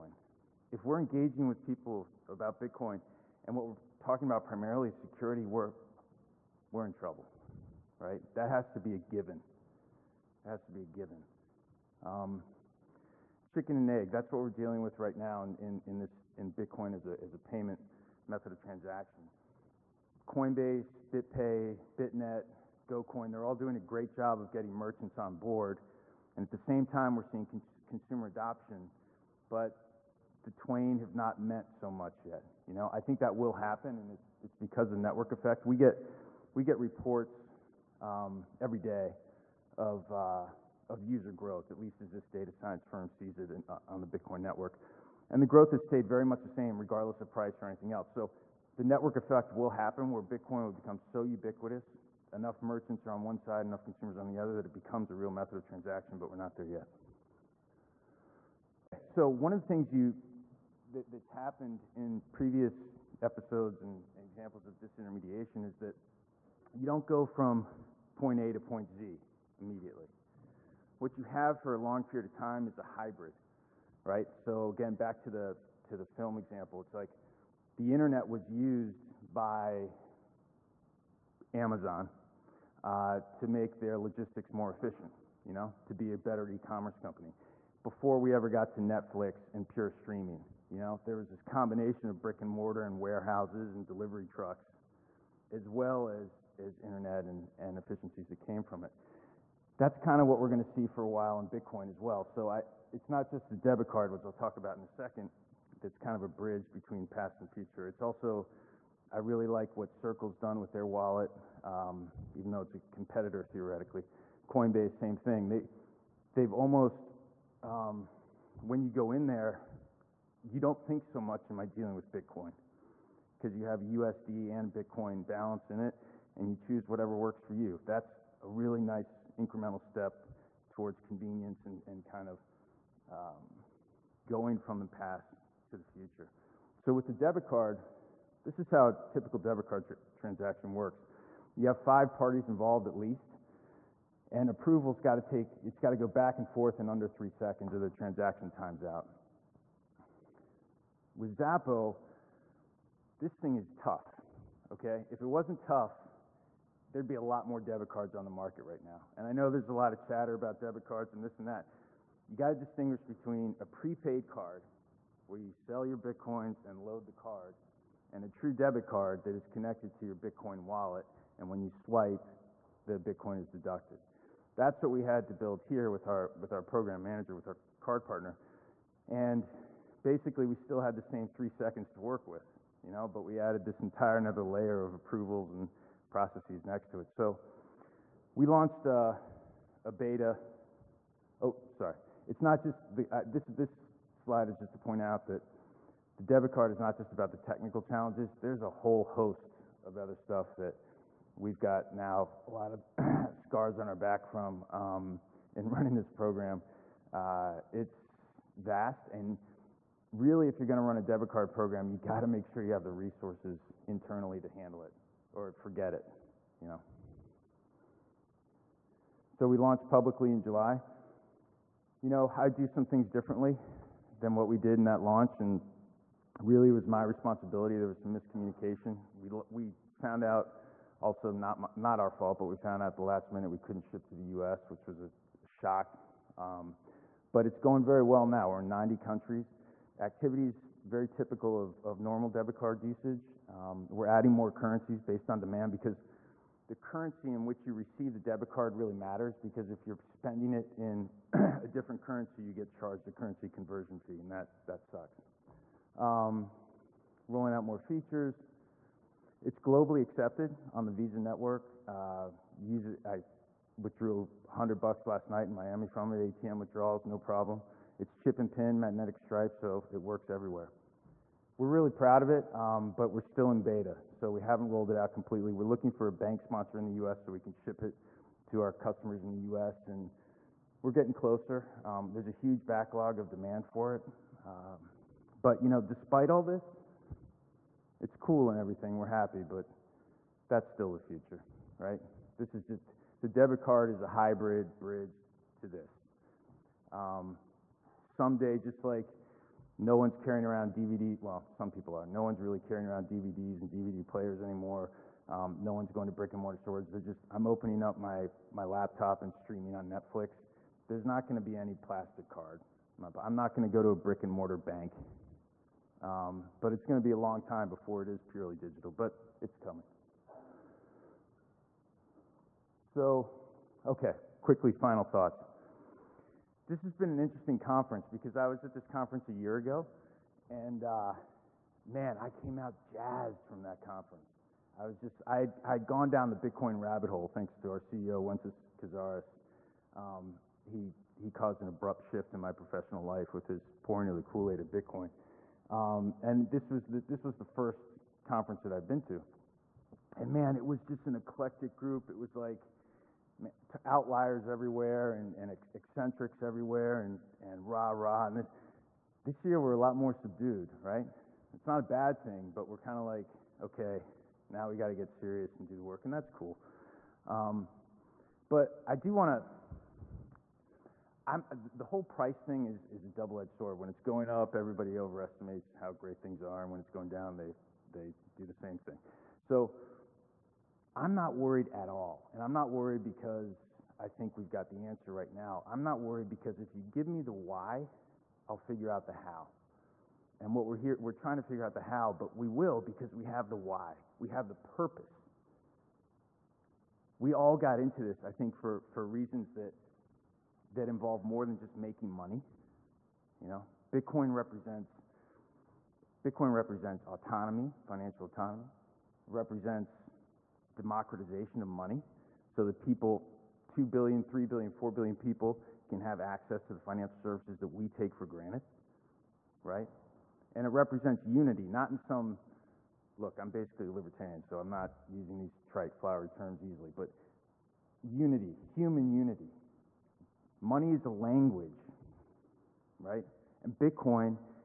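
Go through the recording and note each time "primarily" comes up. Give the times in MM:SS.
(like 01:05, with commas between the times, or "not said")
00:04.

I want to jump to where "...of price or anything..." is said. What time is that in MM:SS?
00:47.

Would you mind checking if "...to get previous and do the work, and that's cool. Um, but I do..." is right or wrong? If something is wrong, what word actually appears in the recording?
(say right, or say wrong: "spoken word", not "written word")
wrong: "serious", not "previous".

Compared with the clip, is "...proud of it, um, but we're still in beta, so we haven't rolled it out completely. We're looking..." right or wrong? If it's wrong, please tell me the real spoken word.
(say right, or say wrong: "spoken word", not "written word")
right.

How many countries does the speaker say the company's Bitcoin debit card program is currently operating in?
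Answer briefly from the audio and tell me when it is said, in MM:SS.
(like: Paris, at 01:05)
90, at 03:58.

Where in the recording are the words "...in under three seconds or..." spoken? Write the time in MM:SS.
02:26.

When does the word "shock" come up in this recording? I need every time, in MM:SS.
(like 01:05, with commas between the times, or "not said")
03:55.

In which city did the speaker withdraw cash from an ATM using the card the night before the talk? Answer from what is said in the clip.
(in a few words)
Miami.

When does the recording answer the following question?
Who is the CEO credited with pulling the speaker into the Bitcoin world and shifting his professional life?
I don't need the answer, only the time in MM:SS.
05:38.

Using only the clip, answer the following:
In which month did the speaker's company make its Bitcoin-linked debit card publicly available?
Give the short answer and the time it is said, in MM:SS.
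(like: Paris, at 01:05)
July, at 03:40.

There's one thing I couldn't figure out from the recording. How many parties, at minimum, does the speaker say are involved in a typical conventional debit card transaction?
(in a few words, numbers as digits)
5.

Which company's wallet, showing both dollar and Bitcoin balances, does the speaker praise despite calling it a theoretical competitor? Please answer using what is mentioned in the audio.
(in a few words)
Circle.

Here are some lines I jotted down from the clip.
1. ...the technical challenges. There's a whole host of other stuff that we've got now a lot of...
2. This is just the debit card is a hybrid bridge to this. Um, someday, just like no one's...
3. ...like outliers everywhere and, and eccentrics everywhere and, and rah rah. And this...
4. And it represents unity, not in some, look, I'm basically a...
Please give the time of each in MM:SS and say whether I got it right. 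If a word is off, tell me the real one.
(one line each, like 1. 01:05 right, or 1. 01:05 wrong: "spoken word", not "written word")
1. 03:17 right
2. 04:52 right
3. 05:52 right
4. 07:00 right.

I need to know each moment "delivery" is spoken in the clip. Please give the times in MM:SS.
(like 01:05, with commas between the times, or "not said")
01:33.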